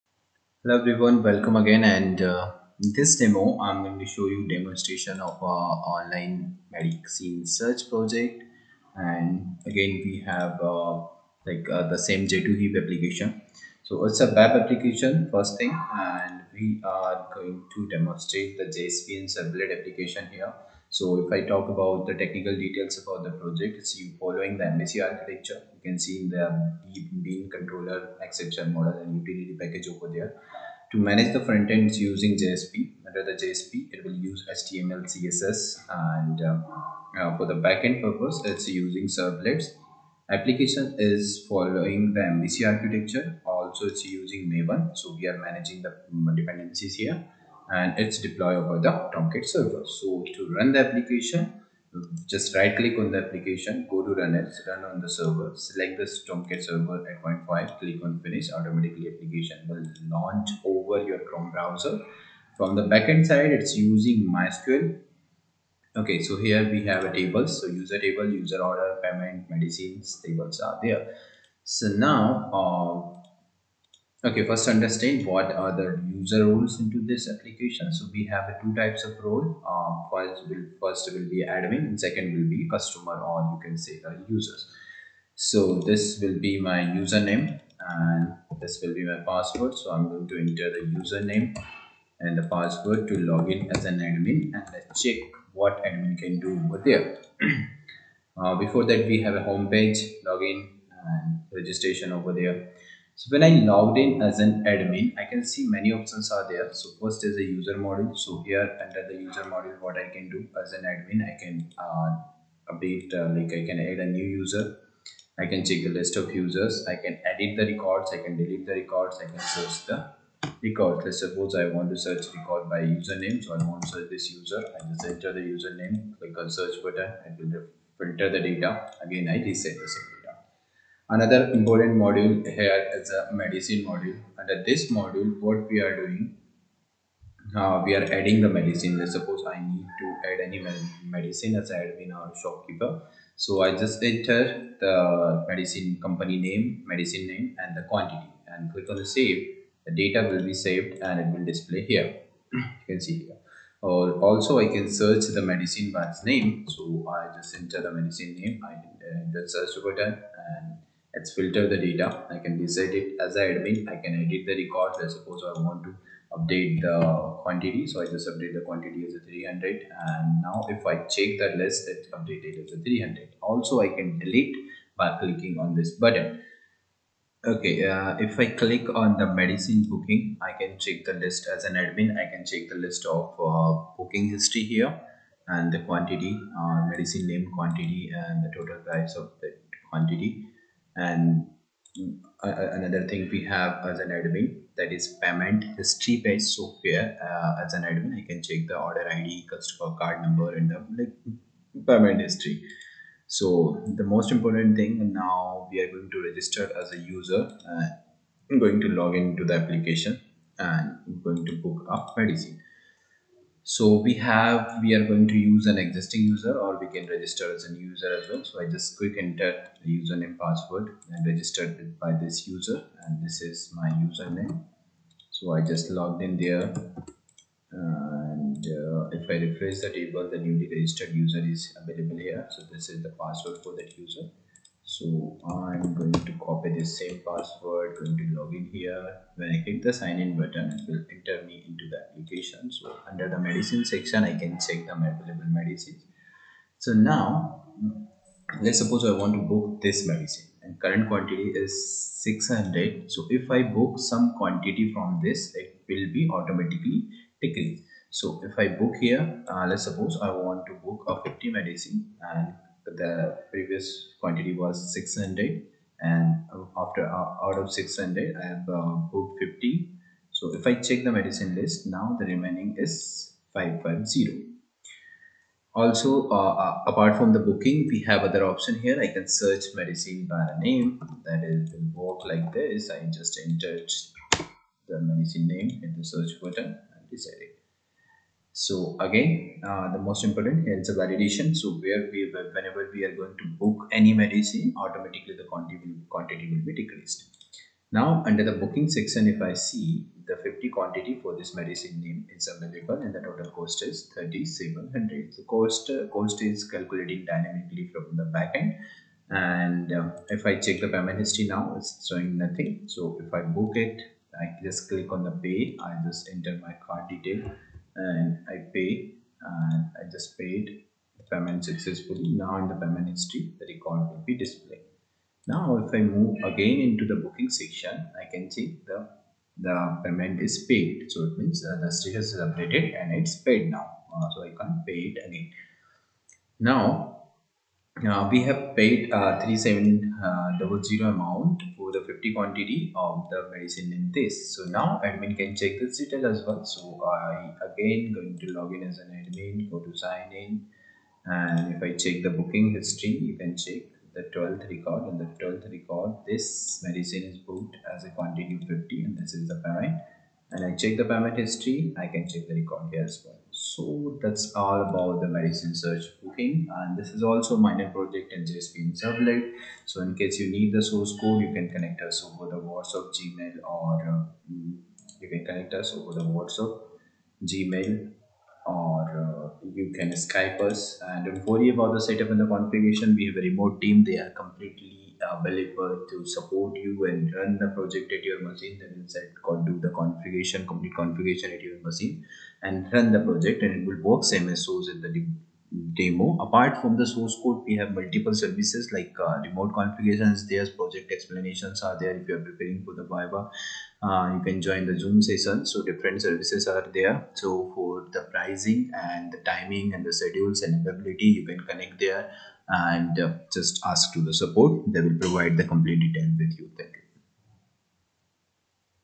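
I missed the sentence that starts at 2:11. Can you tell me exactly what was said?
Another important module here is the medicine module.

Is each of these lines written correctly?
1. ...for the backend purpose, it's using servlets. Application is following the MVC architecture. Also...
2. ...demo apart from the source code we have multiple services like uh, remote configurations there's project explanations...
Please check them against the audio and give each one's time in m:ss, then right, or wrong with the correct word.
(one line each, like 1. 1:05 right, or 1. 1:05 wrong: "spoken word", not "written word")
1. 0:37 right
2. 6:35 right.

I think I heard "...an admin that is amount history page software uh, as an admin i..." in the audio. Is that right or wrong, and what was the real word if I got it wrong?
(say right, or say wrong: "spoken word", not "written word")
wrong: "payment", not "amount".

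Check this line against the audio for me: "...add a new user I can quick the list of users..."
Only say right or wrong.
wrong.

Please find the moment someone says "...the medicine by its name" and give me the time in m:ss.
2:35.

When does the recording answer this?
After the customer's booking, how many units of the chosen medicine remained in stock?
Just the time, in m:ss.
4:33.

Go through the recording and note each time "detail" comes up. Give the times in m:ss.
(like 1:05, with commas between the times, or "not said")
0:22, 5:17, 5:45, 6:55.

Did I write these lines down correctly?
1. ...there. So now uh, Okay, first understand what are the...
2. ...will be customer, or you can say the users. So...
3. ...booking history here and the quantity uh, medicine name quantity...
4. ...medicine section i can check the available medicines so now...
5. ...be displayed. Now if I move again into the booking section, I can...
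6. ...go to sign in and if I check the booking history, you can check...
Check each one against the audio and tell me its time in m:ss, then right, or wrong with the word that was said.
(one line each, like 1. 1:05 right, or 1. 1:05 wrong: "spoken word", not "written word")
1. 1:10 right
2. 1:22 right
3. 3:03 right
4. 4:03 right
5. 5:24 right
6. 5:49 right.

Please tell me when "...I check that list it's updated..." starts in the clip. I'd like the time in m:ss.
2:50.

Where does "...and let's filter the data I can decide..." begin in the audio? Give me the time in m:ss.
2:40.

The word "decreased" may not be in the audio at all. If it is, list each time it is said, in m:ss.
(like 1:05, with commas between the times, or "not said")
4:17, 4:56.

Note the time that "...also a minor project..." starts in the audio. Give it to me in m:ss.
6:07.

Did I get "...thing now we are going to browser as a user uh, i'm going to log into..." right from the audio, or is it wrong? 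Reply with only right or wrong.
wrong.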